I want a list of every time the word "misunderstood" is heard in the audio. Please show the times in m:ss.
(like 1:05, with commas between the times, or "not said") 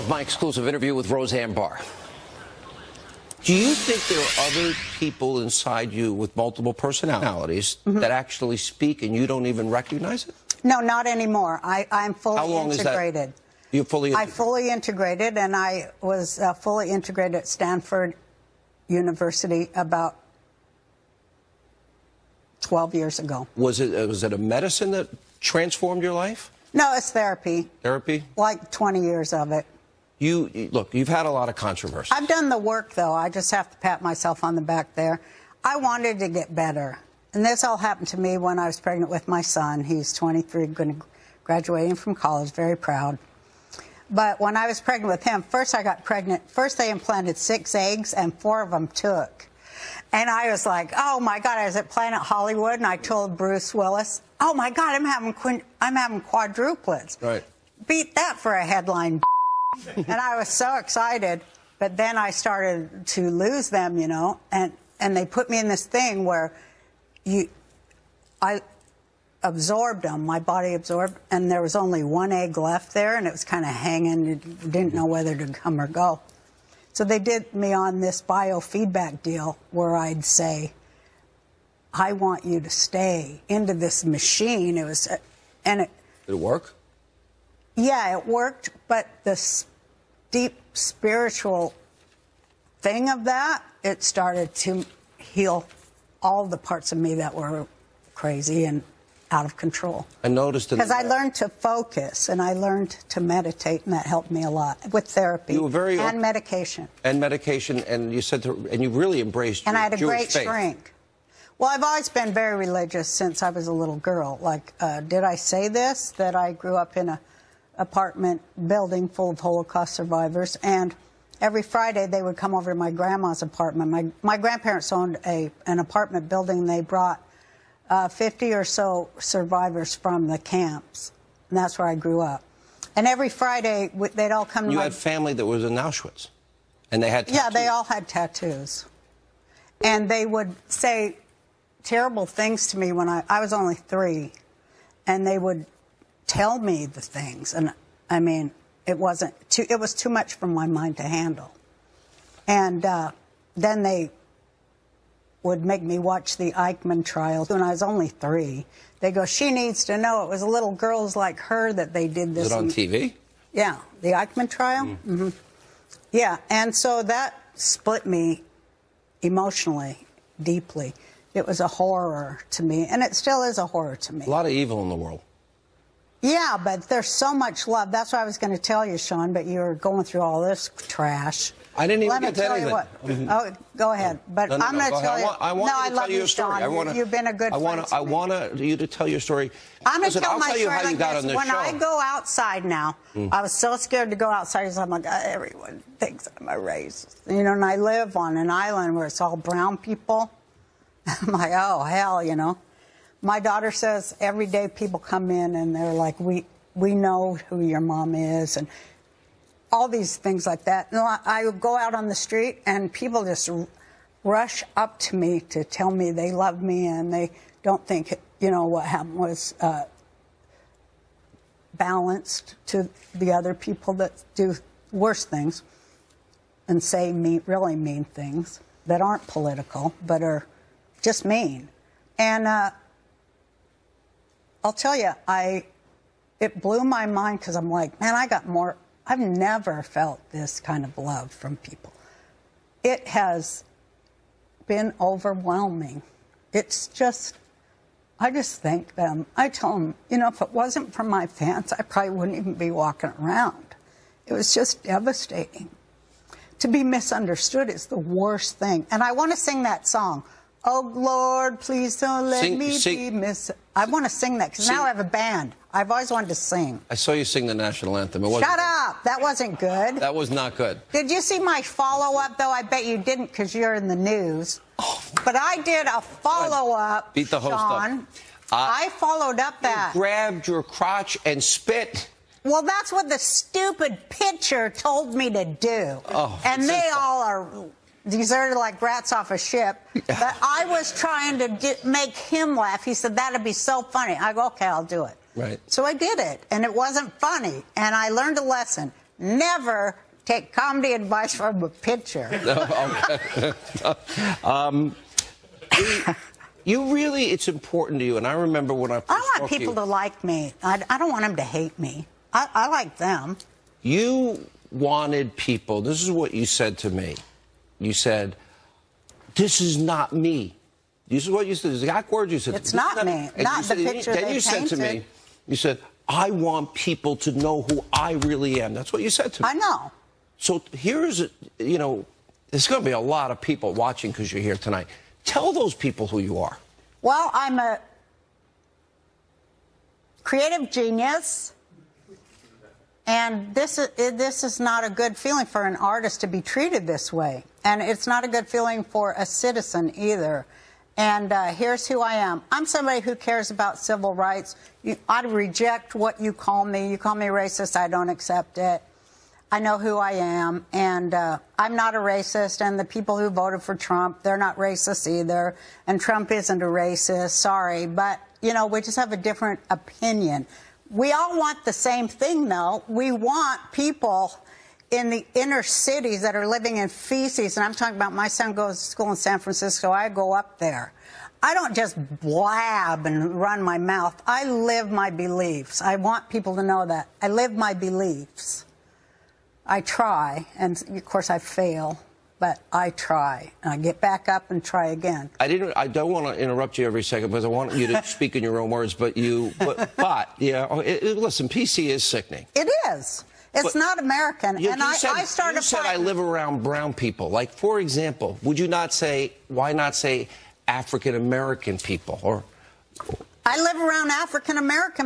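4:16, 4:23.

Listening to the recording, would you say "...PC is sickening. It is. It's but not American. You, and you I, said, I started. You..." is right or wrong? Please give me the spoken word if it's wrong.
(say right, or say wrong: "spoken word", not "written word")
right.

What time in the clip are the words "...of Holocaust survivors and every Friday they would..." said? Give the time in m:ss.
1:59.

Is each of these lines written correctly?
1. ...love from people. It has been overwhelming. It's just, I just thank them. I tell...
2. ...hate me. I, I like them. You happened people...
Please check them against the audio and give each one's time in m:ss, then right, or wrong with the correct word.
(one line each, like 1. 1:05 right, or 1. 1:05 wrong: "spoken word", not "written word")
1. 4:00 right
2. 5:11 wrong: "wanted", not "happened".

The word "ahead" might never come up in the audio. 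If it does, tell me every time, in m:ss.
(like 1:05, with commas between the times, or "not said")
3:03.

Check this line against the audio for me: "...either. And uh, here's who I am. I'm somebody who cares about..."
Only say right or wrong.
right.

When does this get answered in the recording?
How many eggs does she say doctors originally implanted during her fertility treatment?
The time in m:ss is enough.
0:47.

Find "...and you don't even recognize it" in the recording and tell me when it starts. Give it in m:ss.
0:09.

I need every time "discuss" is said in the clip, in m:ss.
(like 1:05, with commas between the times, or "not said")
not said.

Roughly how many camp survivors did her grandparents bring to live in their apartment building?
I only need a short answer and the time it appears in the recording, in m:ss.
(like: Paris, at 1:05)
50, at 2:08.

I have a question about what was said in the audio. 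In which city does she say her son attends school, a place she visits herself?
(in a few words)
San Francisco.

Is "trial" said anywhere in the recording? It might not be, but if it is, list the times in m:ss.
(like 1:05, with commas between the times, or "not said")
2:37, 2:44.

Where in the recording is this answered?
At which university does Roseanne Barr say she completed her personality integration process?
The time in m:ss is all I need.
0:17.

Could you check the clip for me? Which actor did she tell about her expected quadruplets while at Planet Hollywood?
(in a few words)
Bruce Willis.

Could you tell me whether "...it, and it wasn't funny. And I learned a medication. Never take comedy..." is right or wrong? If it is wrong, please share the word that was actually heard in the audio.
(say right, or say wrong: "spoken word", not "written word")
wrong: "lesson", not "medication".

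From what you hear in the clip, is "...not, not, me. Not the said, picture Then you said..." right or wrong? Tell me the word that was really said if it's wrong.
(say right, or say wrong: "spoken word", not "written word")
right.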